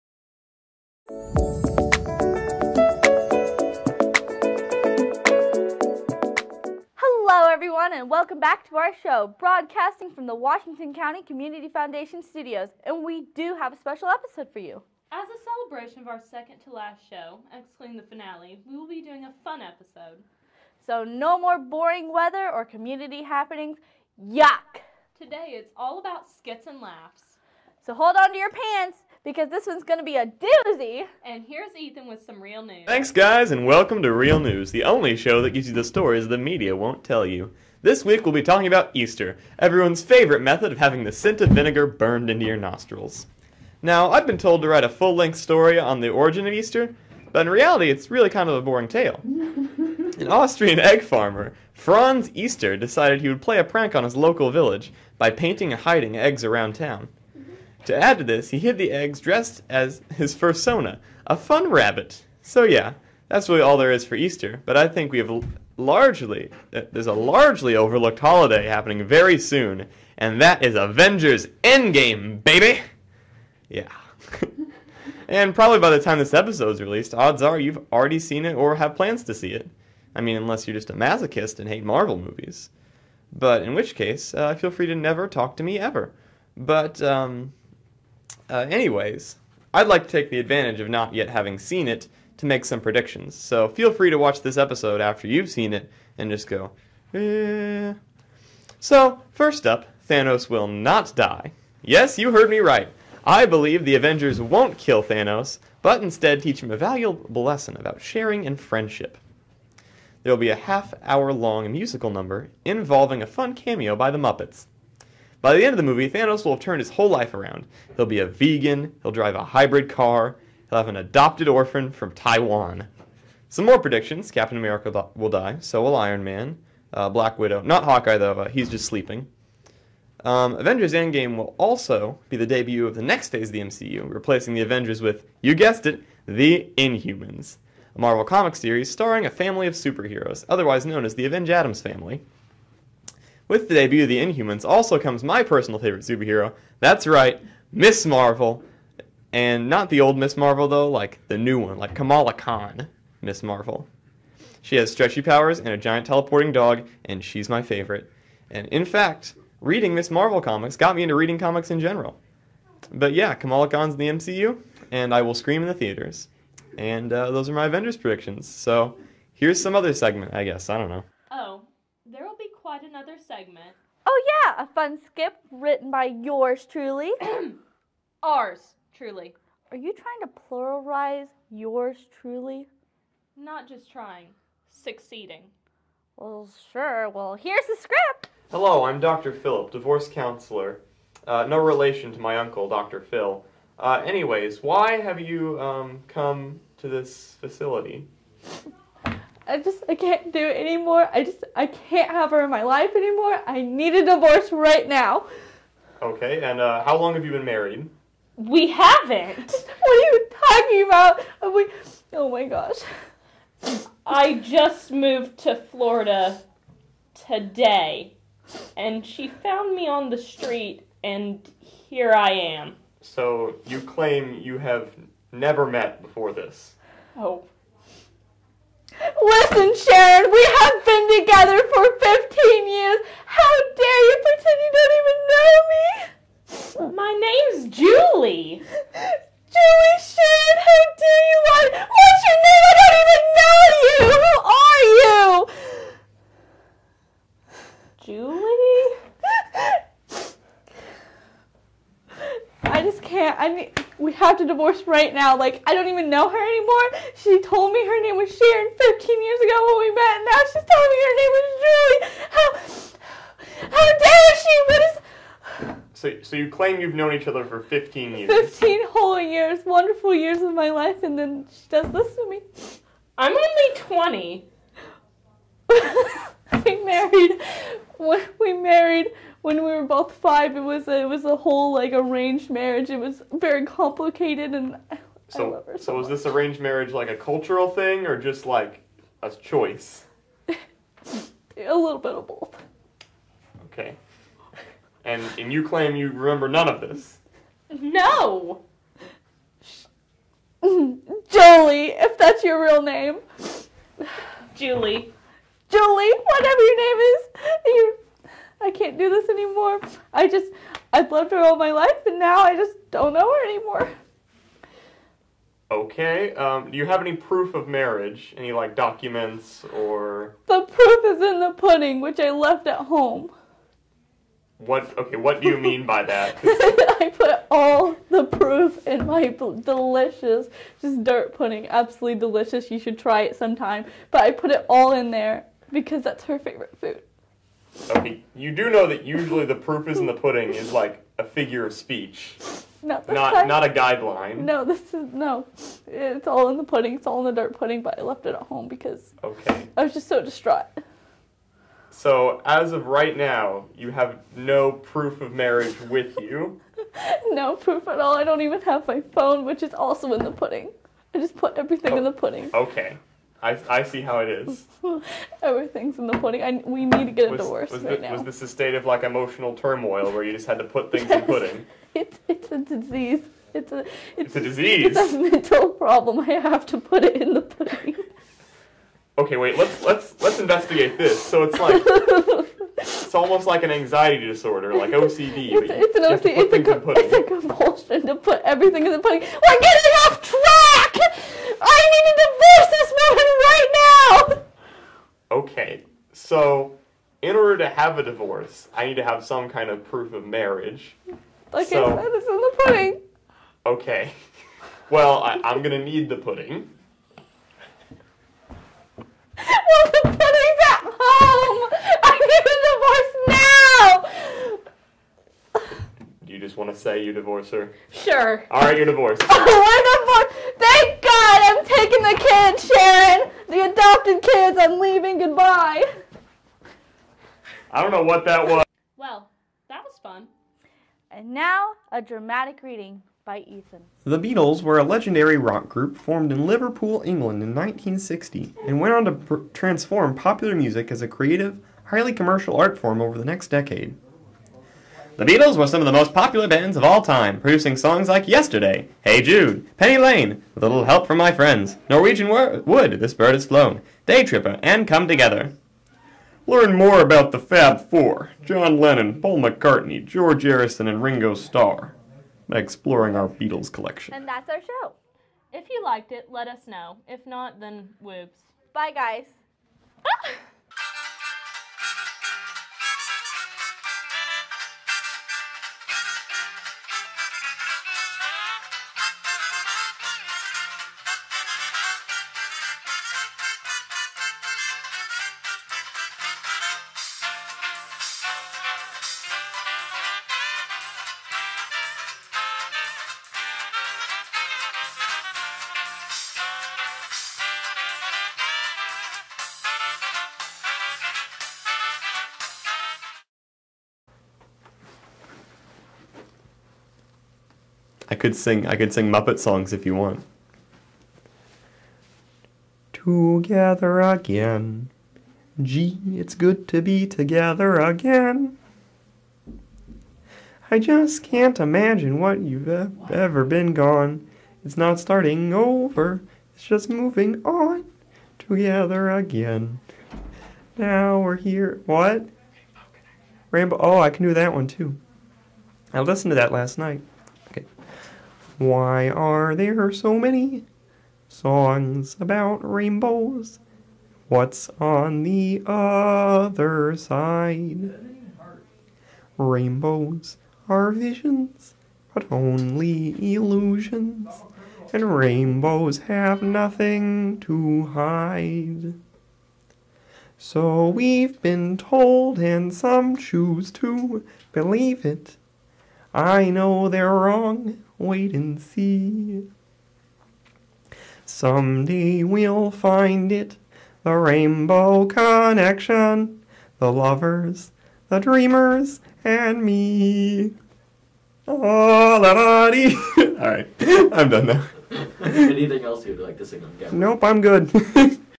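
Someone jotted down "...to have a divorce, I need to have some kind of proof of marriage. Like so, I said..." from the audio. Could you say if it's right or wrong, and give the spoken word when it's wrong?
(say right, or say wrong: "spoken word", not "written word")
right.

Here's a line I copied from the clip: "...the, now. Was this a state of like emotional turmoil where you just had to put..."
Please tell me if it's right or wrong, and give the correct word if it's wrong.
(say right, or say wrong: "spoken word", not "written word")
right.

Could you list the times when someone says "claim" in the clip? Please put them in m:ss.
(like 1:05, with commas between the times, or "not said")
3:43, 4:26, 4:55.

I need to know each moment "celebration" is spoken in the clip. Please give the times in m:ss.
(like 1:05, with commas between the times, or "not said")
0:15.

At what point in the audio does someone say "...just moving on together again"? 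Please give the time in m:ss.
8:46.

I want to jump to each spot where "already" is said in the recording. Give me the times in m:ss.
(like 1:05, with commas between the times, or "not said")
1:17.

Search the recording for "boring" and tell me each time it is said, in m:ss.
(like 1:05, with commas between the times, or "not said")
0:21, 0:48.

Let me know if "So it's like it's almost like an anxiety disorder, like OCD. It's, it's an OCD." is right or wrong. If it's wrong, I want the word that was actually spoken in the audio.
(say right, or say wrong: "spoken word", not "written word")
right.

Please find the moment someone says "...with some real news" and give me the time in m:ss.
0:32.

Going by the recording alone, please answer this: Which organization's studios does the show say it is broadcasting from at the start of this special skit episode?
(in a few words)
Washington County Community Foundation.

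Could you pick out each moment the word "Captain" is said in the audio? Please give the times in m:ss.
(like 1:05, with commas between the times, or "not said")
2:04.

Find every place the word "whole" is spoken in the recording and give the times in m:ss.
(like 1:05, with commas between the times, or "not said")
1:56, 4:28, 4:41.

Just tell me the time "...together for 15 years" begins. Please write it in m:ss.
3:51.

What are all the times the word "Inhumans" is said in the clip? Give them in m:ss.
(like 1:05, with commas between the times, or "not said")
2:16, 2:24.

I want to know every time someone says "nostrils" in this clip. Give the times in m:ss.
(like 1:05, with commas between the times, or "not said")
0:42.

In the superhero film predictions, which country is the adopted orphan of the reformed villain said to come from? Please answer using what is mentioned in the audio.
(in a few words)
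Taiwan.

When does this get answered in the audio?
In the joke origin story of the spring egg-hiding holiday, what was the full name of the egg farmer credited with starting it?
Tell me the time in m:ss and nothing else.
0:51.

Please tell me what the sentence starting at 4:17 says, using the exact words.
She told me her name was Sharon 15 years ago when we met.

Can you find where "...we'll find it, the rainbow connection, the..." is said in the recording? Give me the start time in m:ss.
9:32.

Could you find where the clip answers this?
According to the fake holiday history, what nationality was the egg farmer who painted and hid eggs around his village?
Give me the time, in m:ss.
0:50.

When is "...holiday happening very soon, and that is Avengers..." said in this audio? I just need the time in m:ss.
1:08.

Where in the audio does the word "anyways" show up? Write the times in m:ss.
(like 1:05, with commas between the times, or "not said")
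1:28, 3:14.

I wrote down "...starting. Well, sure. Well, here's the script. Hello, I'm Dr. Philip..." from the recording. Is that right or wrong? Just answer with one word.
wrong.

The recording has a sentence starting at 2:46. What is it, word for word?
And uh, those are my Avengers predictions.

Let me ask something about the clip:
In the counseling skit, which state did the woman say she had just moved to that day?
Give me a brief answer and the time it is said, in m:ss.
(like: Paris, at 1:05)
Florida, at 3:35.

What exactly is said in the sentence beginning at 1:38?
So, first up, Thanos will not die.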